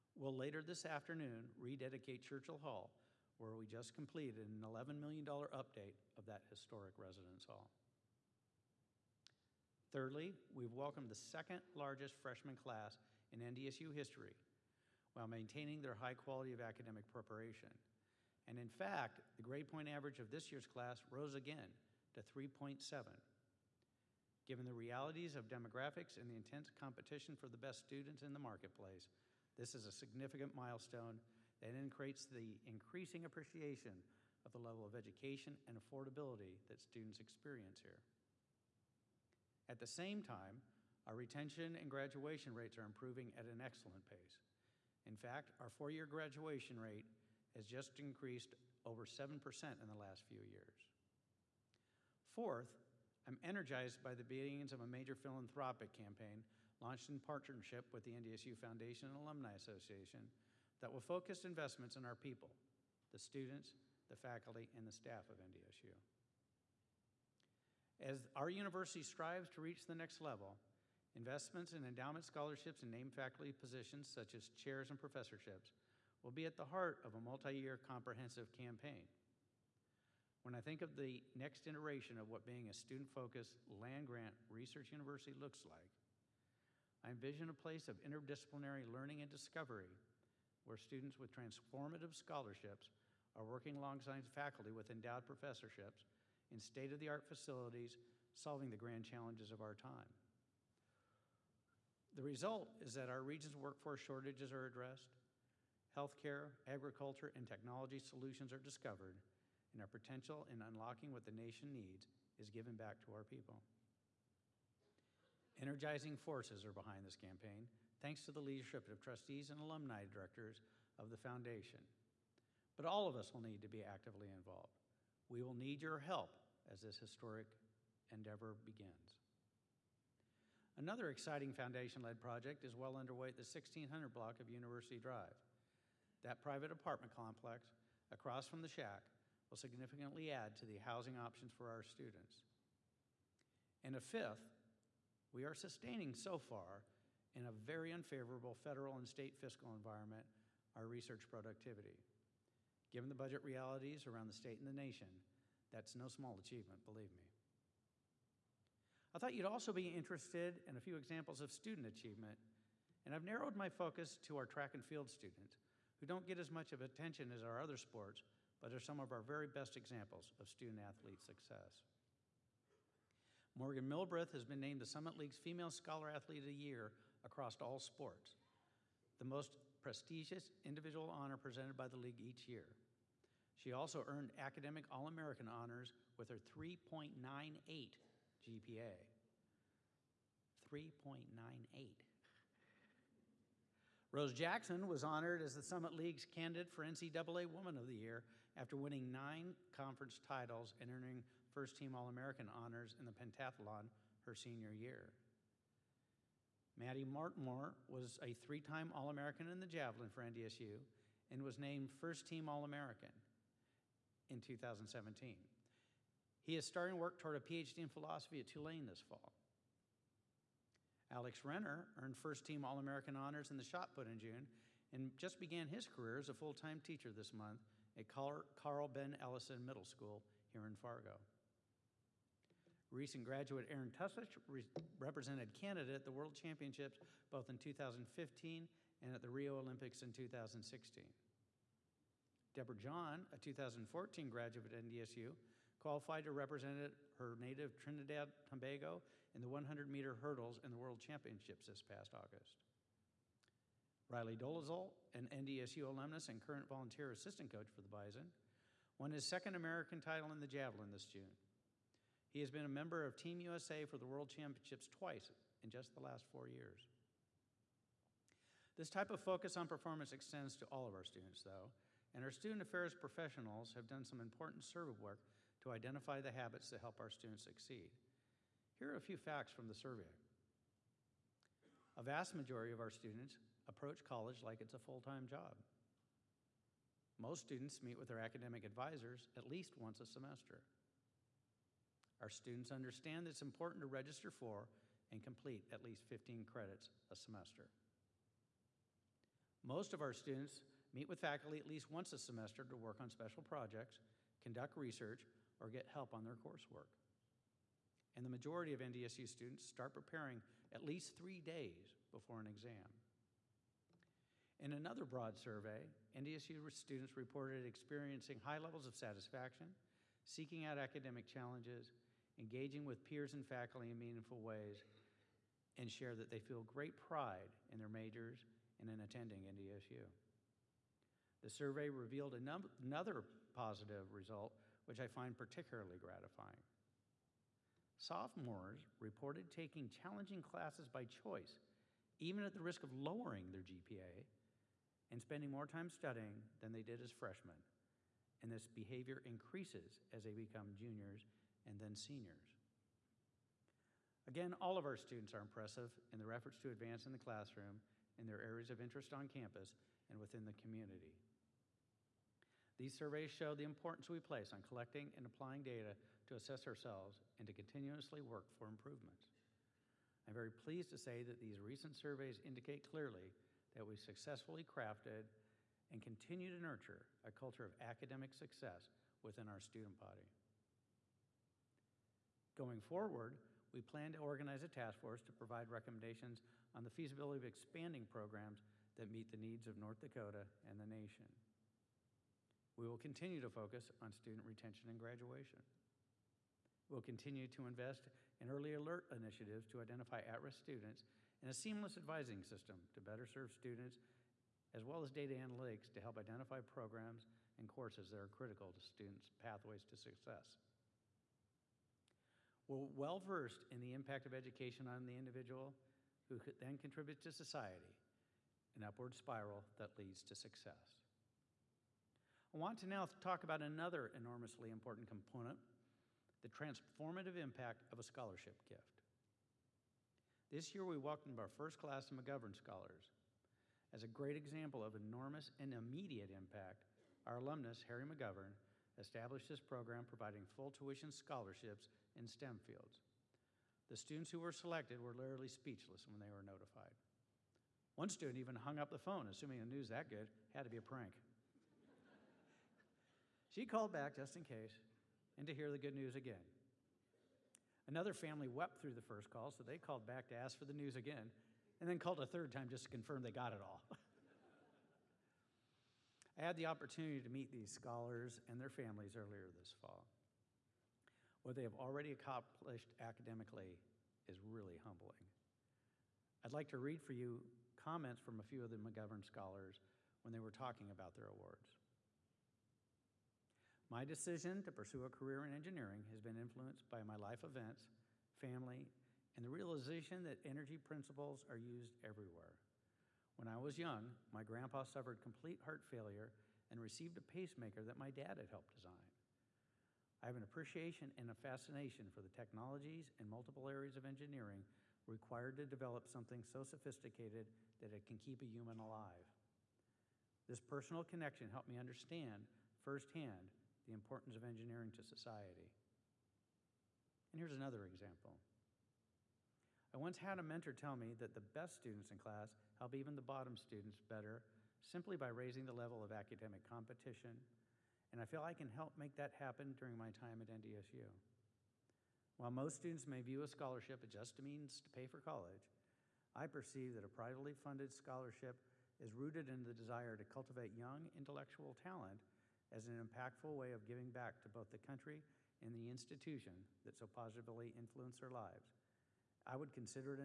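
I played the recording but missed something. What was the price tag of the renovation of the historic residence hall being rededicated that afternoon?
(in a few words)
$11 million.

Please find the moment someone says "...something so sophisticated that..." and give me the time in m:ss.
8:26.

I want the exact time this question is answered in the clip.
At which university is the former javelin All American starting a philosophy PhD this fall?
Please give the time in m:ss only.
3:38.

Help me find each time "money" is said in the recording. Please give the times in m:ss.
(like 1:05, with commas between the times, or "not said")
not said.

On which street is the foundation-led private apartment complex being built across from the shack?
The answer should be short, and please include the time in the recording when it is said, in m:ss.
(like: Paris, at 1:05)
University Drive, at 2:14.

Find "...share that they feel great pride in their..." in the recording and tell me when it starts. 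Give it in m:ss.
5:25.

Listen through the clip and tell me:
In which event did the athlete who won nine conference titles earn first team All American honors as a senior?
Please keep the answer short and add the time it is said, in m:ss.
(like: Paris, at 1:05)
pentathlon, at 3:23.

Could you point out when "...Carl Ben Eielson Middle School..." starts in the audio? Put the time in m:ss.
3:48.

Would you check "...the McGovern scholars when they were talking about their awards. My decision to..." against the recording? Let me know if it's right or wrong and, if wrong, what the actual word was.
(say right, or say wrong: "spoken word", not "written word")
right.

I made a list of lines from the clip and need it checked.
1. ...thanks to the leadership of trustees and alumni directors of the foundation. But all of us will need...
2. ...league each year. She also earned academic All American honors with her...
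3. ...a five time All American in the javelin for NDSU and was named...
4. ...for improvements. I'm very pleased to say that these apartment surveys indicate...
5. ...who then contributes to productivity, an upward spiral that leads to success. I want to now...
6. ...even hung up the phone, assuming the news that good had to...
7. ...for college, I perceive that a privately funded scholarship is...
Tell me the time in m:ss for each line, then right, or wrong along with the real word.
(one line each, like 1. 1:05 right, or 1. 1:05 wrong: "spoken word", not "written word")
1. 1:57 right
2. 3:01 right
3. 3:28 wrong: "three", not "five"
4. 6:08 wrong: "recent", not "apartment"
5. 6:56 wrong: "society", not "productivity"
6. 7:28 right
7. 8:55 right.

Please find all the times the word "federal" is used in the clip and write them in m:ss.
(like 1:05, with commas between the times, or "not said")
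2:28.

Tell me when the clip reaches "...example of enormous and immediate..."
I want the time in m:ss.
7:14.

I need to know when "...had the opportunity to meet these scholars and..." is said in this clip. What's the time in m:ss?
7:46.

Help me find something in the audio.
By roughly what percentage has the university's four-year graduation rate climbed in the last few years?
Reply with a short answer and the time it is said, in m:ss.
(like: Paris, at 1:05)
7%, at 0:49.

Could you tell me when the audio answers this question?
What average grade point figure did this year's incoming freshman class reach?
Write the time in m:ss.
0:22.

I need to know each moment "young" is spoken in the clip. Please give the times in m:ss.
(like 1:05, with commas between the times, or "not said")
8:13, 9:00.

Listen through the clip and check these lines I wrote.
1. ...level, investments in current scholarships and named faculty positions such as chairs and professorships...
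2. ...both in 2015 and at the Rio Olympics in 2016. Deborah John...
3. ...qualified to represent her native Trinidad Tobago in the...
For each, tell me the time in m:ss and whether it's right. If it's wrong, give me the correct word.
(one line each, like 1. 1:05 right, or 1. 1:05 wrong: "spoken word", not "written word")
1. 1:10 wrong: "endowment", not "current"
2. 3:57 right
3. 4:05 right.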